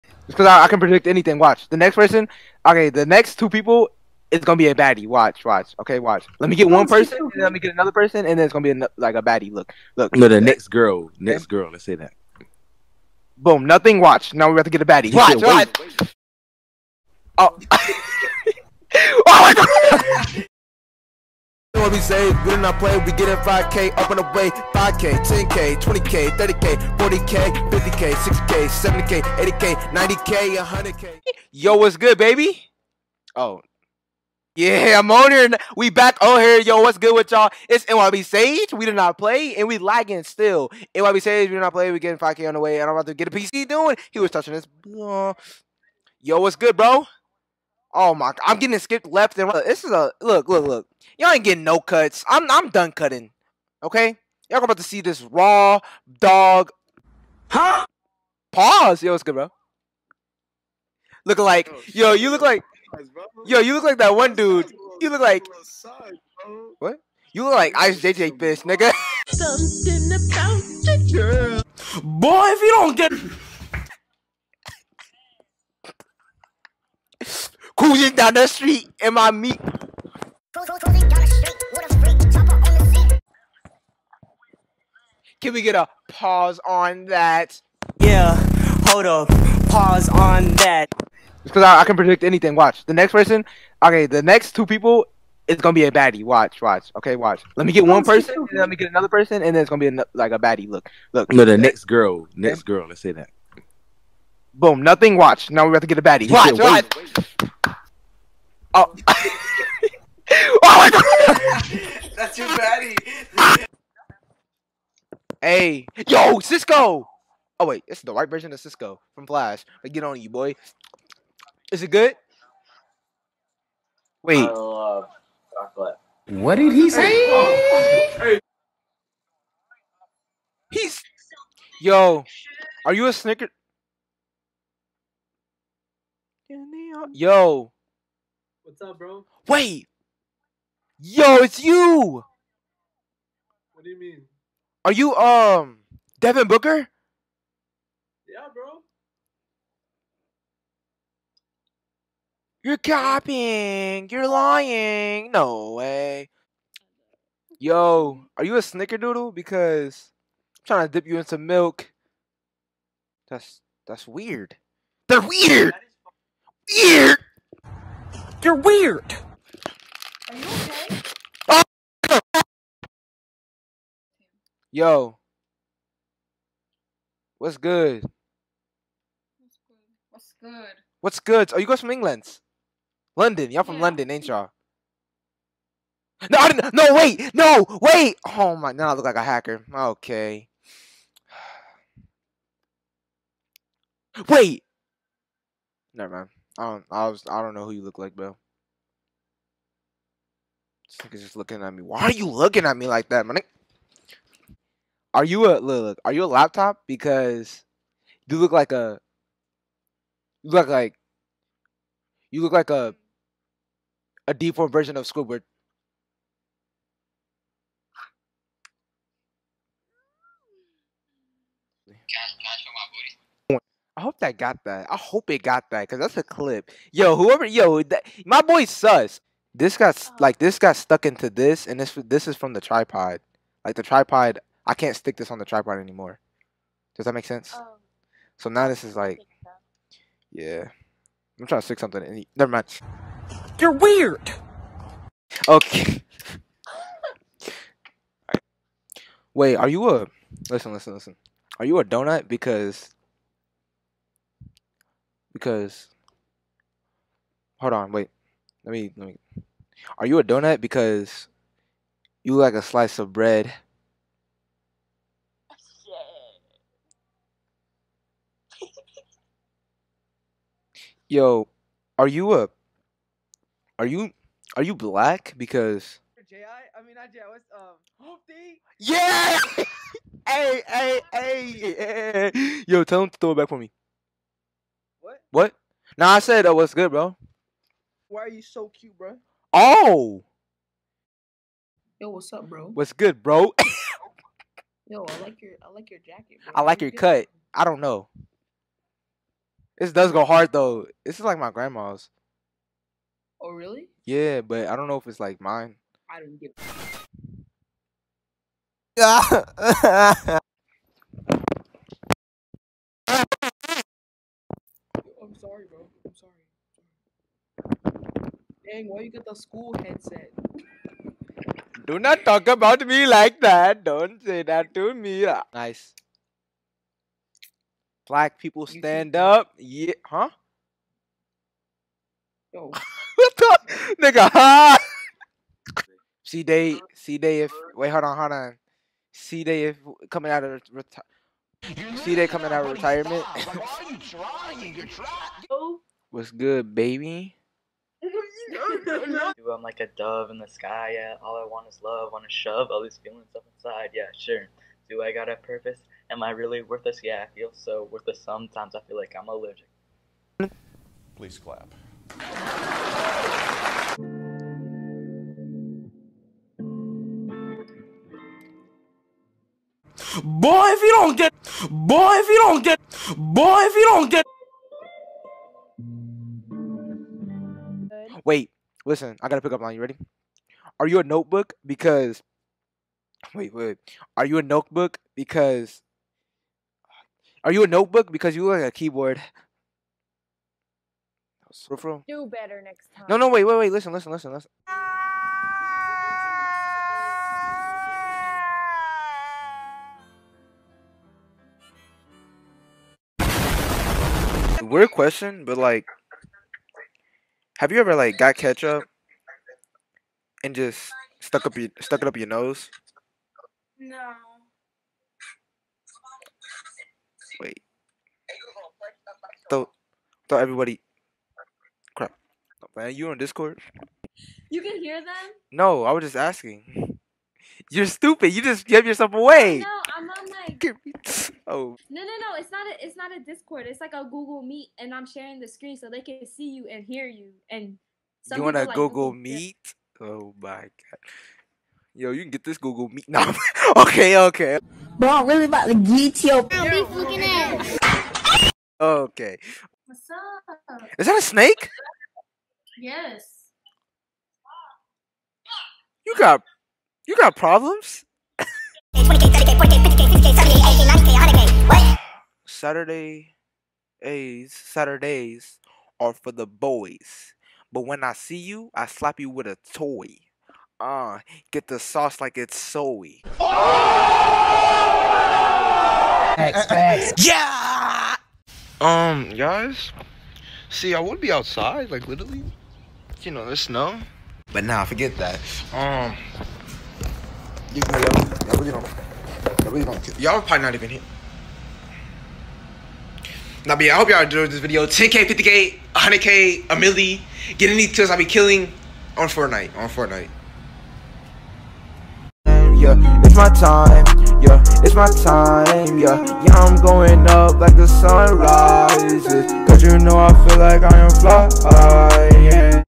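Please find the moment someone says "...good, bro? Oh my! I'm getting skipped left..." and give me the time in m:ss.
0:46.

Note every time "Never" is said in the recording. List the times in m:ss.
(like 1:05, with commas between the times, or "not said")
3:15, 4:02.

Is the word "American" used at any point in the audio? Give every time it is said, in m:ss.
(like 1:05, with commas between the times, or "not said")
not said.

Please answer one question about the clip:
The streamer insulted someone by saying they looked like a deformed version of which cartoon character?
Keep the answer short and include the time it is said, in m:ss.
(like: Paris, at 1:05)
Squidward, at 3:35.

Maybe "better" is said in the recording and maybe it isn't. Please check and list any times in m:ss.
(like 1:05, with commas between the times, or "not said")
6:32.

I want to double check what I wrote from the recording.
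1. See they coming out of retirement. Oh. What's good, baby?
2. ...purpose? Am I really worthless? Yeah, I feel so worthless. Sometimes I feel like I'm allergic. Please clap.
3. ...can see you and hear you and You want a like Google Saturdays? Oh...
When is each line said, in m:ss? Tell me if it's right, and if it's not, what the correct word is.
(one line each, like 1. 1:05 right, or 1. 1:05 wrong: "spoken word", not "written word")
1. 5:41 right
2. 5:55 right
3. 7:15 wrong: "Meet", not "Saturdays".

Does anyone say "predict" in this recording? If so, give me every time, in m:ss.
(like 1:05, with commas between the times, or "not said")
0:00, 1:31.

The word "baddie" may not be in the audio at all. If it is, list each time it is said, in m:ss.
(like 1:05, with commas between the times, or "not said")
0:04, 0:09, 0:14, 1:35, 1:40, 1:46.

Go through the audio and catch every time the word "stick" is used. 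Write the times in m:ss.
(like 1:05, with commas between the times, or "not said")
3:54, 4:01.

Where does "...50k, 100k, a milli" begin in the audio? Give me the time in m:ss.
8:15.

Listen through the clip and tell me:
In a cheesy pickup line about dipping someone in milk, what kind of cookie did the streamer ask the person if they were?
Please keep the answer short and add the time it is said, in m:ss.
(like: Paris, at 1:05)
snickerdoodle, at 2:38.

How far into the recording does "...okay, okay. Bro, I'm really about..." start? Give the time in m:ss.
7:23.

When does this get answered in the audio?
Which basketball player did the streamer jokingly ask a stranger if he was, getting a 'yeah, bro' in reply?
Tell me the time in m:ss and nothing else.
2:26.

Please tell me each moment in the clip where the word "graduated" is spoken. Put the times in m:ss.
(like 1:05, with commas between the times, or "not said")
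not said.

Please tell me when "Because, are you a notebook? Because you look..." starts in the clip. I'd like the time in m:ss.
6:25.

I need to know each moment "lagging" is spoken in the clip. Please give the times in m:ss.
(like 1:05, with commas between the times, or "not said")
0:39.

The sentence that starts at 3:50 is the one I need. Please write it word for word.
like this got stuck into this, and this this is from the tripod.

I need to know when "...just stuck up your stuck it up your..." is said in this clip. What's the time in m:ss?
6:50.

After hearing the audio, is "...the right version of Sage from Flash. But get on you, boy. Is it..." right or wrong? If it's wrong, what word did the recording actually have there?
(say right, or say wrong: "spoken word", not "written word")
wrong: "Cisco", not "Sage".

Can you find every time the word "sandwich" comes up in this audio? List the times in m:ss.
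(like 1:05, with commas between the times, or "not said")
not said.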